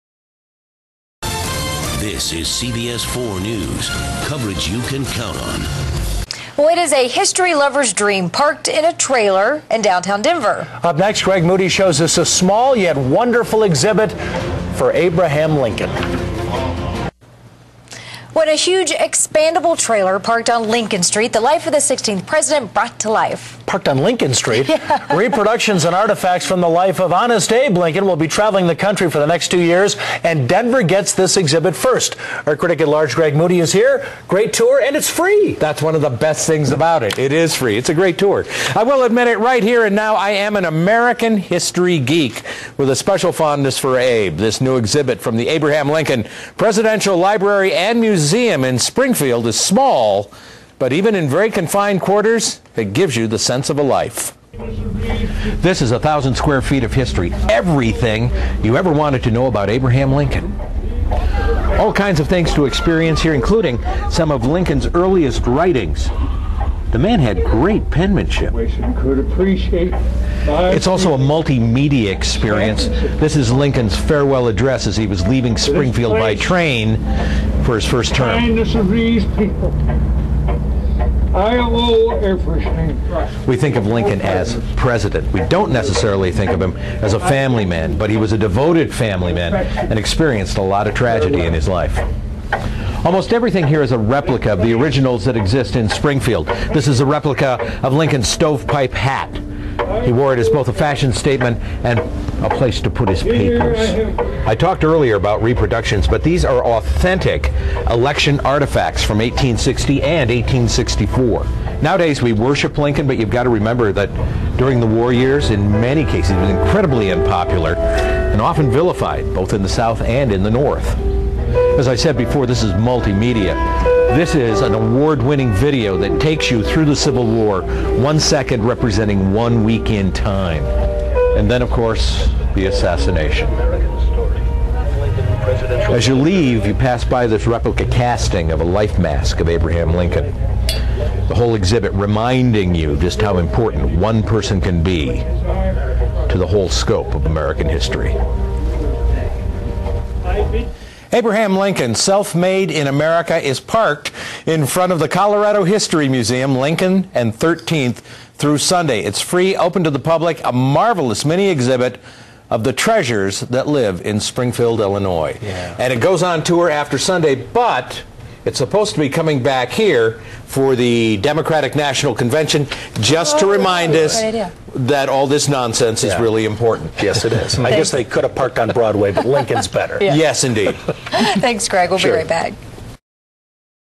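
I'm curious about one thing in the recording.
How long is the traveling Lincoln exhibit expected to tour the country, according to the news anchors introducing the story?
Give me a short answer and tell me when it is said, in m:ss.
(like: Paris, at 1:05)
2 years, at 0:29.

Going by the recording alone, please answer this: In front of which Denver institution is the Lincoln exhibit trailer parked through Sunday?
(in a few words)
Colorado History Museum.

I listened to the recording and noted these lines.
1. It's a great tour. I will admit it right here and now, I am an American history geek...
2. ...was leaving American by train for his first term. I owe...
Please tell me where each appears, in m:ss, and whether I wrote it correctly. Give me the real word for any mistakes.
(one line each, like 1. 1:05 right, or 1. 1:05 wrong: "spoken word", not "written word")
1. 0:37 right
2. 1:15 wrong: "Springfield", not "American".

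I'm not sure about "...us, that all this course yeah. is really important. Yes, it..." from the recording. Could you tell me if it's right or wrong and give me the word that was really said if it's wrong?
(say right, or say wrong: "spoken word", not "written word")
wrong: "nonsense", not "course".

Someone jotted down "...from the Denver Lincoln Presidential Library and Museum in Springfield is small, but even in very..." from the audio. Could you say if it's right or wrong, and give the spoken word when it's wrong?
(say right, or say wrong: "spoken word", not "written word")
wrong: "Abraham", not "Denver".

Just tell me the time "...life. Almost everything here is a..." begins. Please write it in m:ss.
1:31.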